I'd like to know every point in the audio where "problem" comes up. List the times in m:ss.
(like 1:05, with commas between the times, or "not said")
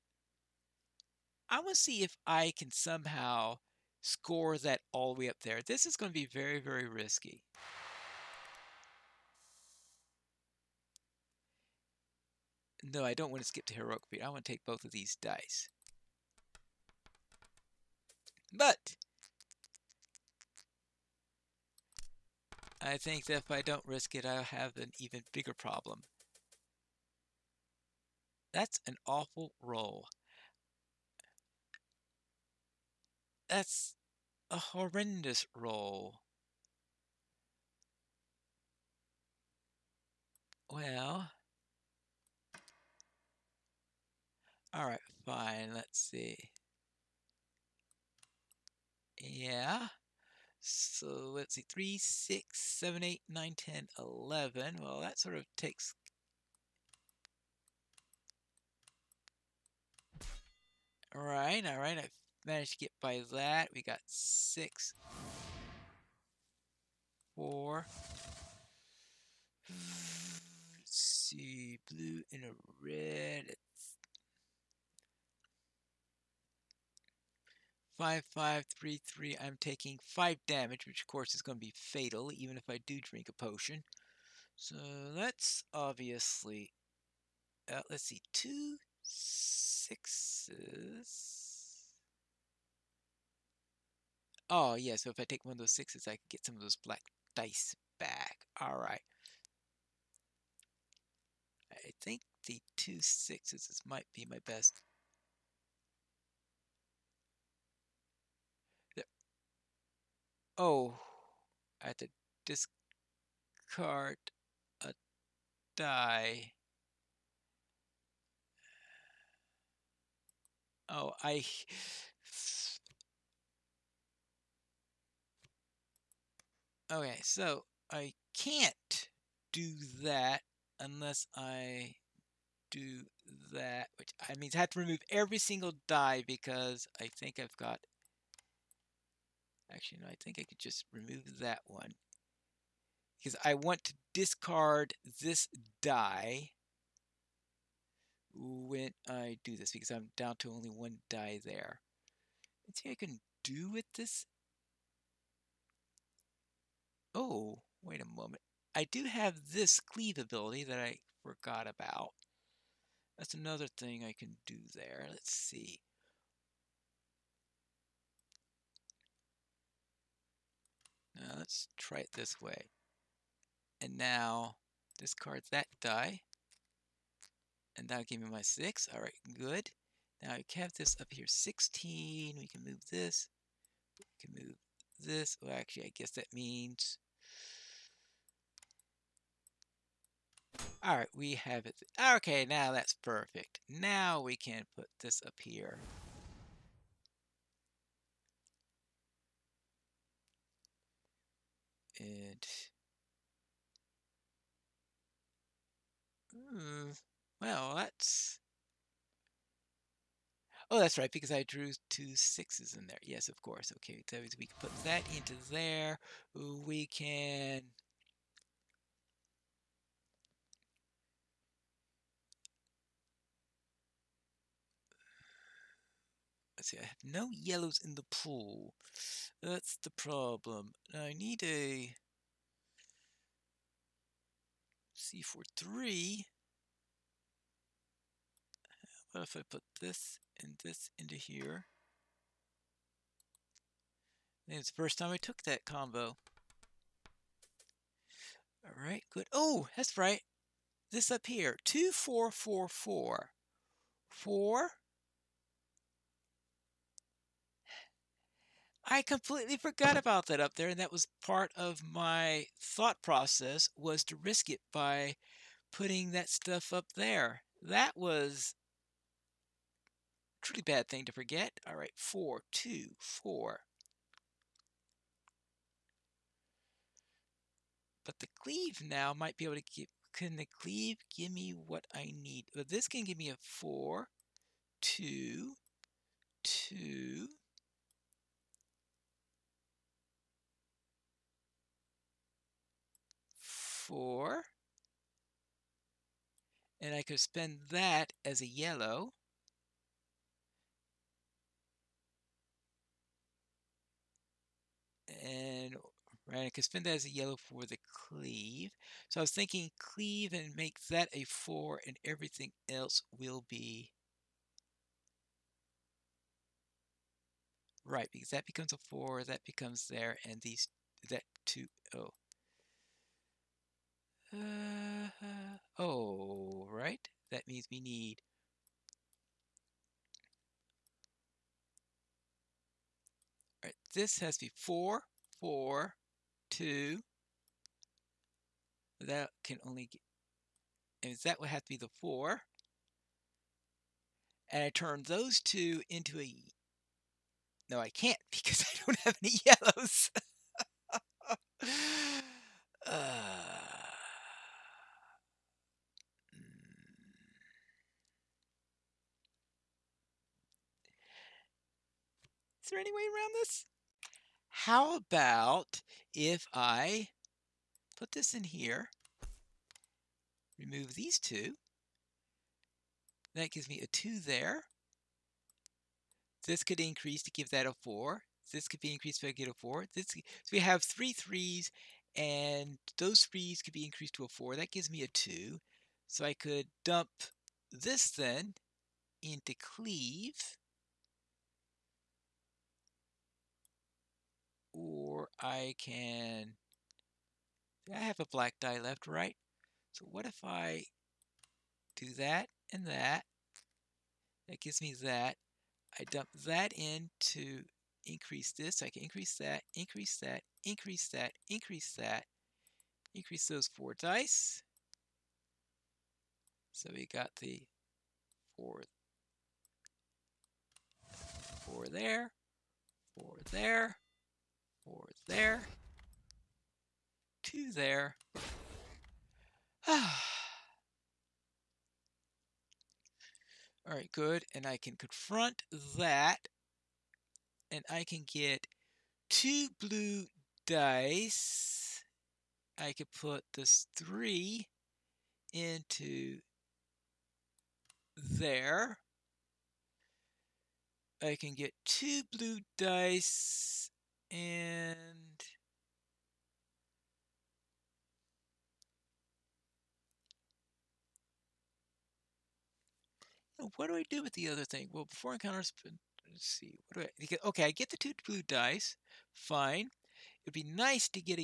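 0:25, 3:49.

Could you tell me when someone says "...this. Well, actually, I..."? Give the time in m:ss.
3:05.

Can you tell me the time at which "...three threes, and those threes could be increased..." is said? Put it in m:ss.
6:20.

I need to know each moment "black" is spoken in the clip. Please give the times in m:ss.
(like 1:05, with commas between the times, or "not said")
1:36, 6:38.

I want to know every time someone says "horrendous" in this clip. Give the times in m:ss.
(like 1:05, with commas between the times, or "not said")
0:34.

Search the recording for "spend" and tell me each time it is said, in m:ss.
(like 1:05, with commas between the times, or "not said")
4:57, 5:06.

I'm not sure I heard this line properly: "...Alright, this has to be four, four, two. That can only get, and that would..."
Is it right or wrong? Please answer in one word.
right.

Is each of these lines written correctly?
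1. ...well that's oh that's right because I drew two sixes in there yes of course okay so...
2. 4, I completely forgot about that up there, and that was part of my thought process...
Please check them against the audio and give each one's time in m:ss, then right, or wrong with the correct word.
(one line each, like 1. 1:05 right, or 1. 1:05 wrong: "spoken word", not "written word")
1. 3:27 right
2. 4:14 right.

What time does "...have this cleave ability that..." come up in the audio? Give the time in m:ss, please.
2:39.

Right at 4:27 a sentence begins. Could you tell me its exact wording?
That was truly bad thing to forget.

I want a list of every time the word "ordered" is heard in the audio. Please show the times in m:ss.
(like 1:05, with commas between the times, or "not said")
not said.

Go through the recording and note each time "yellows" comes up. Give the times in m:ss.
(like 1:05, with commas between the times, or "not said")
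3:47, 4:58, 5:07, 5:49.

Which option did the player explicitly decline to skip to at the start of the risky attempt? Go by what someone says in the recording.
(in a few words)
Heroic feat.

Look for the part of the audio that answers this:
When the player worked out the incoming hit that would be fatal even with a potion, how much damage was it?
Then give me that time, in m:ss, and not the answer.
1:20.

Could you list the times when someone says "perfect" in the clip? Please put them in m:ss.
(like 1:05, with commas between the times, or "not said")
3:12.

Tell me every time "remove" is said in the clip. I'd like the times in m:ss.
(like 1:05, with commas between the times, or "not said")
2:14, 2:20, 6:10.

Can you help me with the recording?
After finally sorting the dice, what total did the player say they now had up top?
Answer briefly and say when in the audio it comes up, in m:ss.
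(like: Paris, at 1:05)
16, at 3:01.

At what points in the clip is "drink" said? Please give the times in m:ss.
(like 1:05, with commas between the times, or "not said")
1:22.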